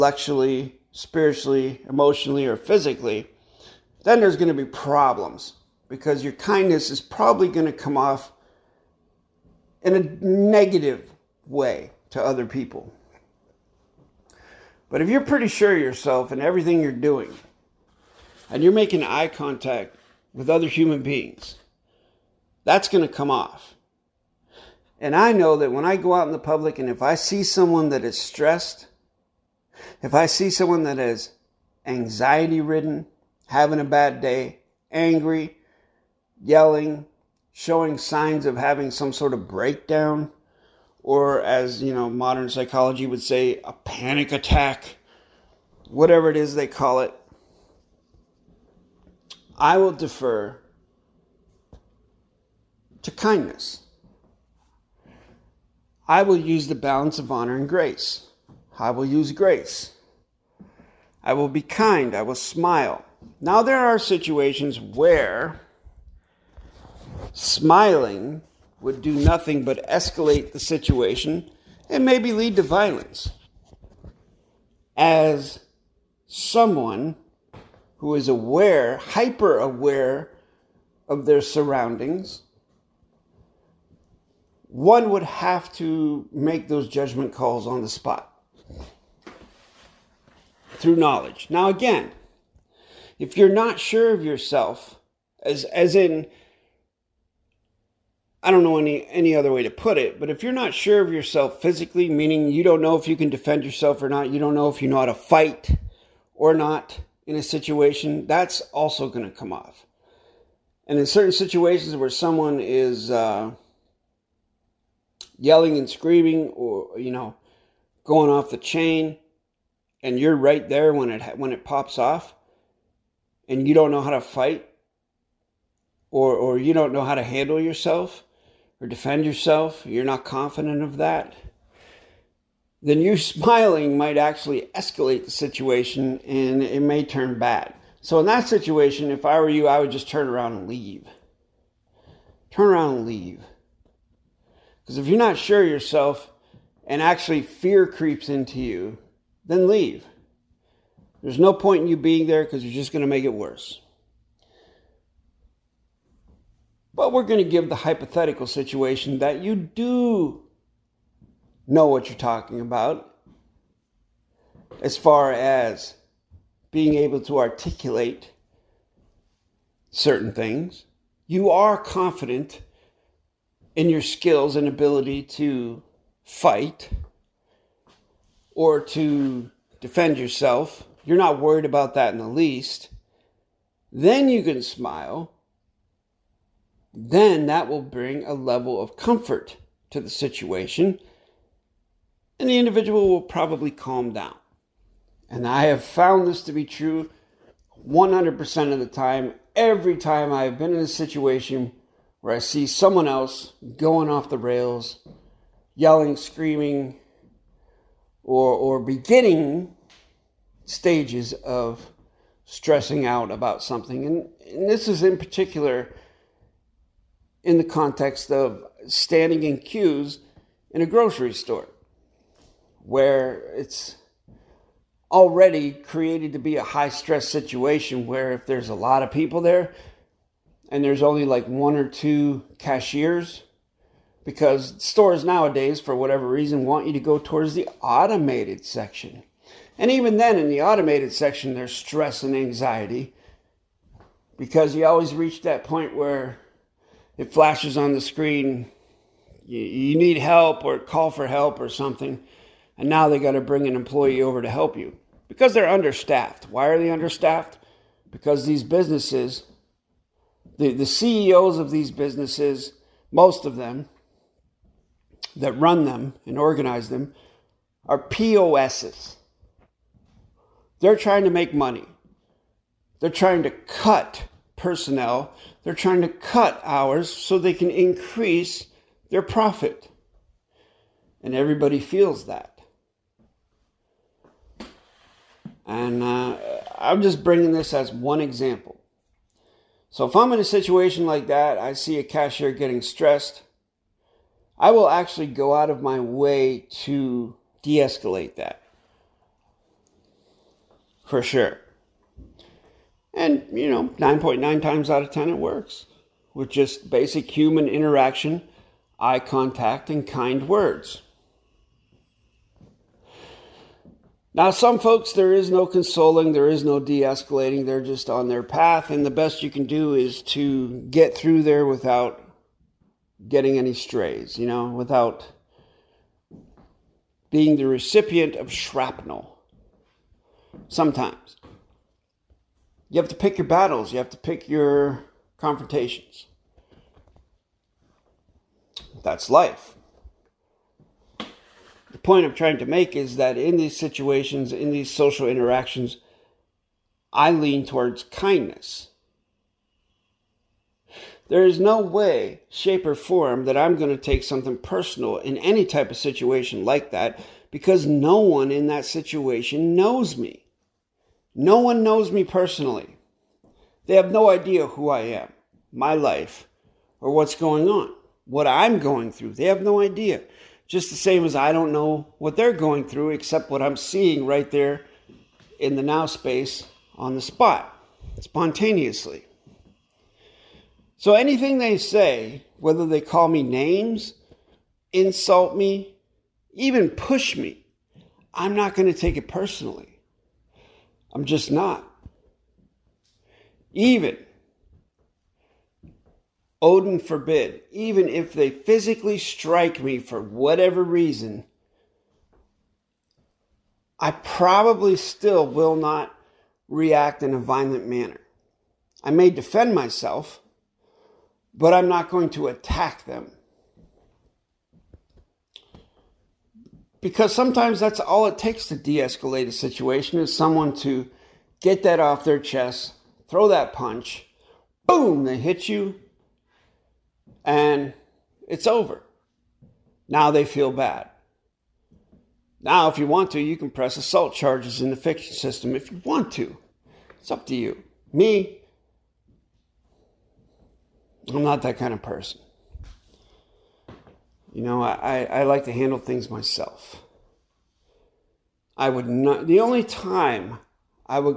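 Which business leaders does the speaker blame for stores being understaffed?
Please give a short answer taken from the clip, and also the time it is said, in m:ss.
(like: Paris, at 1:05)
the CEOs, at 4:20.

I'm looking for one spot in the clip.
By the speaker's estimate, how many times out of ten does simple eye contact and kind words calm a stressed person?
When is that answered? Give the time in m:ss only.
5:03.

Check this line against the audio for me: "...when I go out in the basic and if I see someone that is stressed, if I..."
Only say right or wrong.
wrong.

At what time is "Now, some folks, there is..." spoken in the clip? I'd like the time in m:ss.
5:14.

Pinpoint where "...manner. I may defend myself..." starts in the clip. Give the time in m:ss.
6:47.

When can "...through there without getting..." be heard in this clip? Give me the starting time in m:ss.
5:21.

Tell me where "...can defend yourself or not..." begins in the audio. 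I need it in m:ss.
1:43.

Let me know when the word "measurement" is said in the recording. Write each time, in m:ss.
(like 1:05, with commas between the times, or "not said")
not said.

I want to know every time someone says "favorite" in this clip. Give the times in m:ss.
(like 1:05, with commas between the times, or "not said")
not said.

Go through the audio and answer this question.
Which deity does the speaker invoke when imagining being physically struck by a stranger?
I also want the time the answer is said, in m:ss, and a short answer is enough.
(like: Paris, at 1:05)
Odin, at 6:36.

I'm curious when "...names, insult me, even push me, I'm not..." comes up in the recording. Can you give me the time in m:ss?
6:23.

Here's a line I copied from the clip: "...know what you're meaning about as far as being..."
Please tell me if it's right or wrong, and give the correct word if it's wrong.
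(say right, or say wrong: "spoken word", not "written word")
wrong: "talking", not "meaning".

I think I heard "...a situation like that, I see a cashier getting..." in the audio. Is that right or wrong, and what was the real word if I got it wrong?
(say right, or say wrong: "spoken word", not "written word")
right.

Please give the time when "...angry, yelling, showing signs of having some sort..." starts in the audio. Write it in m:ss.
0:34.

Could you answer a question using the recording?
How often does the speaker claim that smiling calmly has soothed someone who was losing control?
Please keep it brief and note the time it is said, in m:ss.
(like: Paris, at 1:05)
100% of the time, at 3:17.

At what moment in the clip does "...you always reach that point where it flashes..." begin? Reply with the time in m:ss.
4:04.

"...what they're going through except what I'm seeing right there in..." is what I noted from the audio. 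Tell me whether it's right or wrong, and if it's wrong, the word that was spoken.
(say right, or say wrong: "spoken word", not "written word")
right.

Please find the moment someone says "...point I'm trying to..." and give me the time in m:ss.
5:41.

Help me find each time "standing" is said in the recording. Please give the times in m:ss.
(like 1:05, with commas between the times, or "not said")
3:38.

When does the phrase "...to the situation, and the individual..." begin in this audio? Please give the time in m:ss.
3:09.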